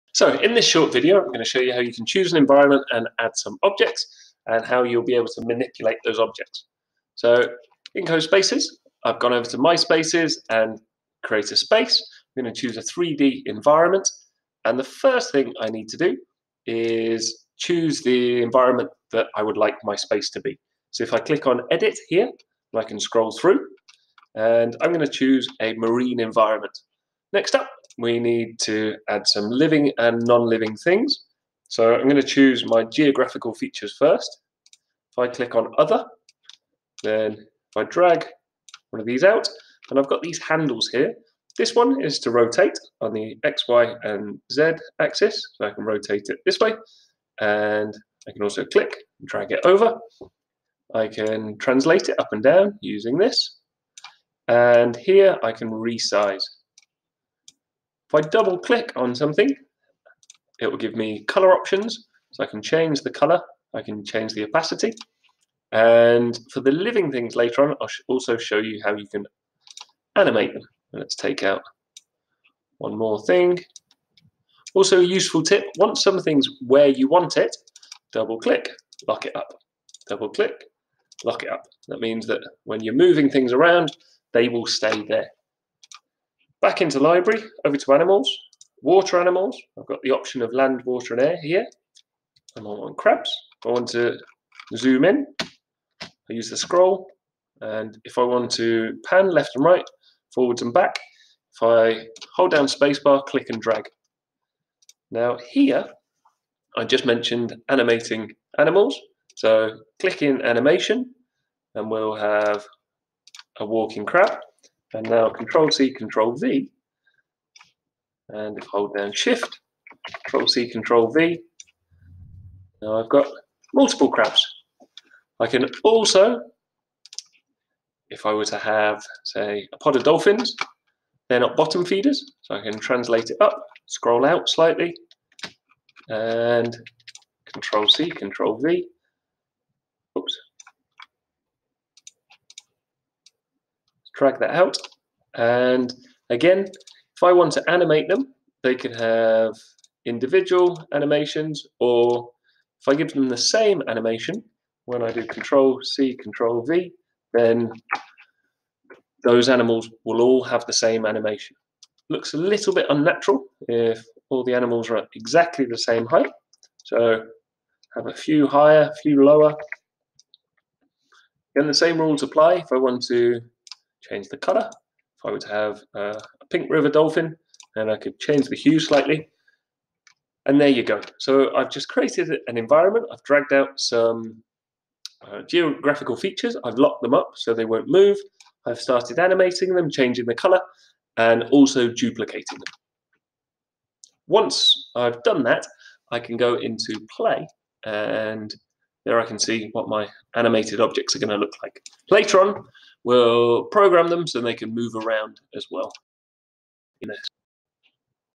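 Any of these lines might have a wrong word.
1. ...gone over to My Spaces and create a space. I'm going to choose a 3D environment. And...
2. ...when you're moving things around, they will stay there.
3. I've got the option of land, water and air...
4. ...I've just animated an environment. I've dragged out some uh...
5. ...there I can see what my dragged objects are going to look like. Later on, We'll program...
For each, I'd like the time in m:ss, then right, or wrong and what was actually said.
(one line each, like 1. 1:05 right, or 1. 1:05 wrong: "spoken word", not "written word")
1. 0:09 right
2. 1:22 right
3. 1:29 right
4. 3:01 wrong: "created", not "animated"
5. 3:19 wrong: "animated", not "dragged".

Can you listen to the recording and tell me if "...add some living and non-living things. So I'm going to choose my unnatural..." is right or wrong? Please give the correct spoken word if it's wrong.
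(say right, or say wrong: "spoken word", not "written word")
wrong: "geographical", not "unnatural".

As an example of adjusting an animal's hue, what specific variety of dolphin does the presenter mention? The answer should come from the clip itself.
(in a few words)
Pink river dolphin.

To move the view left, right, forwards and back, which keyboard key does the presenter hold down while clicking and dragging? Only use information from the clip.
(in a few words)
Spacebar.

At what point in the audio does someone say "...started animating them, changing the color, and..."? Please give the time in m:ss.
3:08.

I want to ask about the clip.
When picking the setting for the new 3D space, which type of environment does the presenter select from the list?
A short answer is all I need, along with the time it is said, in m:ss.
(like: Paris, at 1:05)
Marine, at 0:25.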